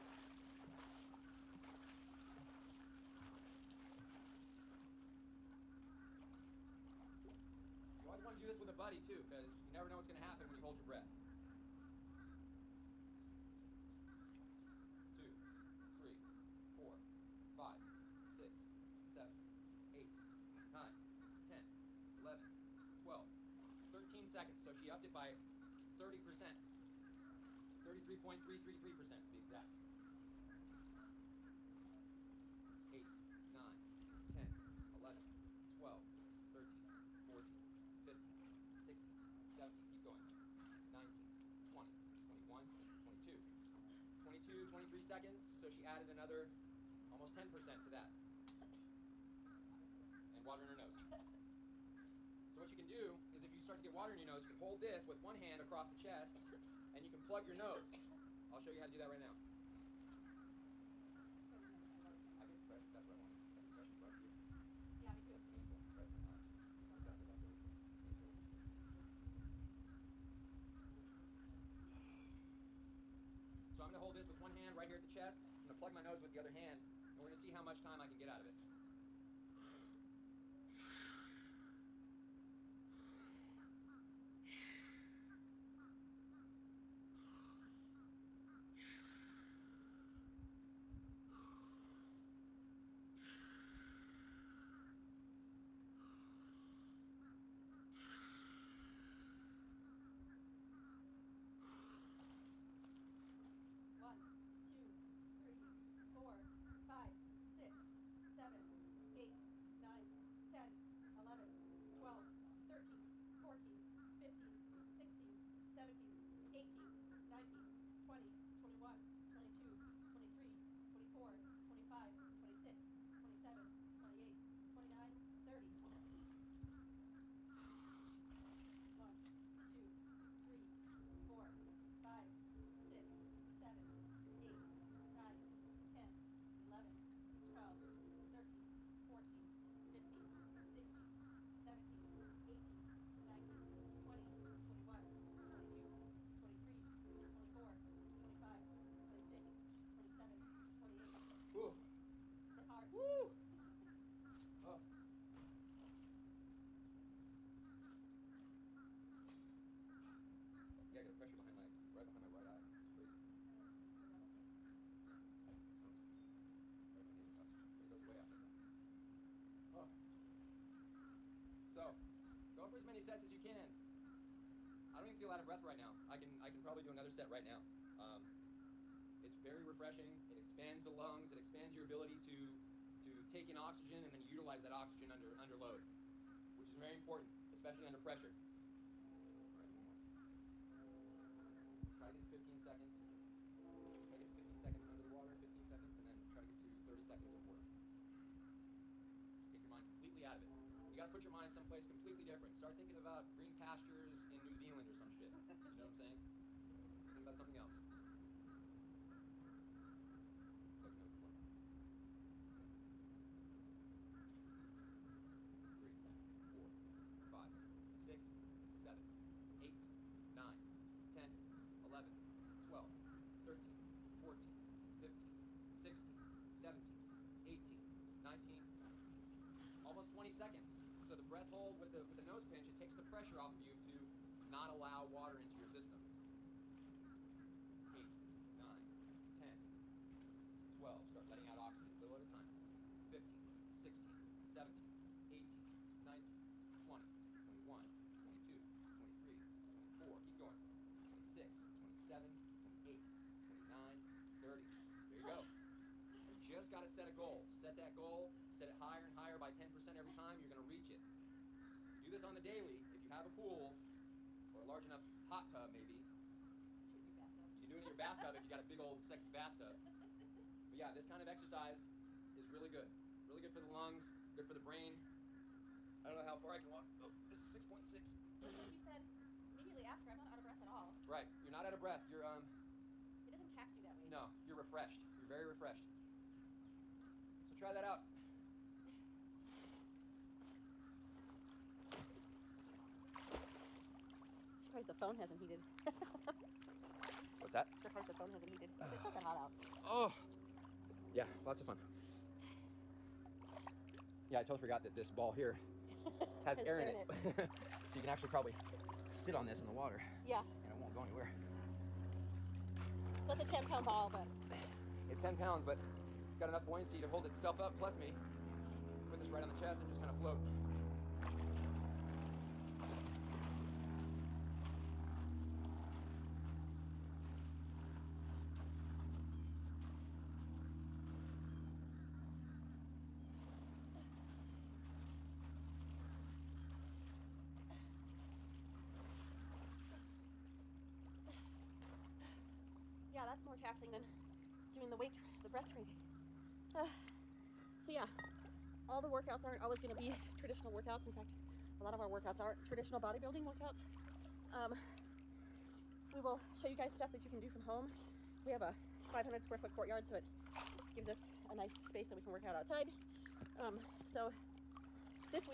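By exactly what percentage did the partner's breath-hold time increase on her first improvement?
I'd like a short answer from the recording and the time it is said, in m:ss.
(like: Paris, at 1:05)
33.333%, at 0:27.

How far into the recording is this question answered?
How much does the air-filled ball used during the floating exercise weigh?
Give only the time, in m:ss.
5:13.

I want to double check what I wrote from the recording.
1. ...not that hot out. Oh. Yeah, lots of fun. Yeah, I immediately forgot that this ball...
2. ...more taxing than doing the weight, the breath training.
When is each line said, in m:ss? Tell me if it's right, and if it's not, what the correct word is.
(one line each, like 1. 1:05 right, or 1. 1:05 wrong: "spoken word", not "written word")
1. 4:59 wrong: "totally", not "immediately"
2. 5:43 right.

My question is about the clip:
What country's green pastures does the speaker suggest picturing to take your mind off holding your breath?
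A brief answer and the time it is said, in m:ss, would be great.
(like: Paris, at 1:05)
New Zealand, at 3:24.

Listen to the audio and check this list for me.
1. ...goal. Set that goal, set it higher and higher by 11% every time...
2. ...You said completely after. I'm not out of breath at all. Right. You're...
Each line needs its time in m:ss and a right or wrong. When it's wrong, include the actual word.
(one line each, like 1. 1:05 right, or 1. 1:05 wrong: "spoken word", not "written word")
1. 4:17 wrong: "10", not "11"
2. 4:38 wrong: "immediately", not "completely".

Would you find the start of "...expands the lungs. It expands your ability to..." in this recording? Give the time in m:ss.
3:00.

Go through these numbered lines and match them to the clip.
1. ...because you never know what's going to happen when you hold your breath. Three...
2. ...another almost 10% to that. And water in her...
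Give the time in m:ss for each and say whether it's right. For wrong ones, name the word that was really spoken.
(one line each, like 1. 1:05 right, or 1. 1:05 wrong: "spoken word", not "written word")
1. 0:09 wrong: "Two", not "Three"
2. 0:46 right.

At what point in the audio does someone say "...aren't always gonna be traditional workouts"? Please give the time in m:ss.
5:49.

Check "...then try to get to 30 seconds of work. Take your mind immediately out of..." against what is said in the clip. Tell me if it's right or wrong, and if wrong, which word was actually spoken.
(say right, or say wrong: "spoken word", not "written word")
wrong: "completely", not "immediately".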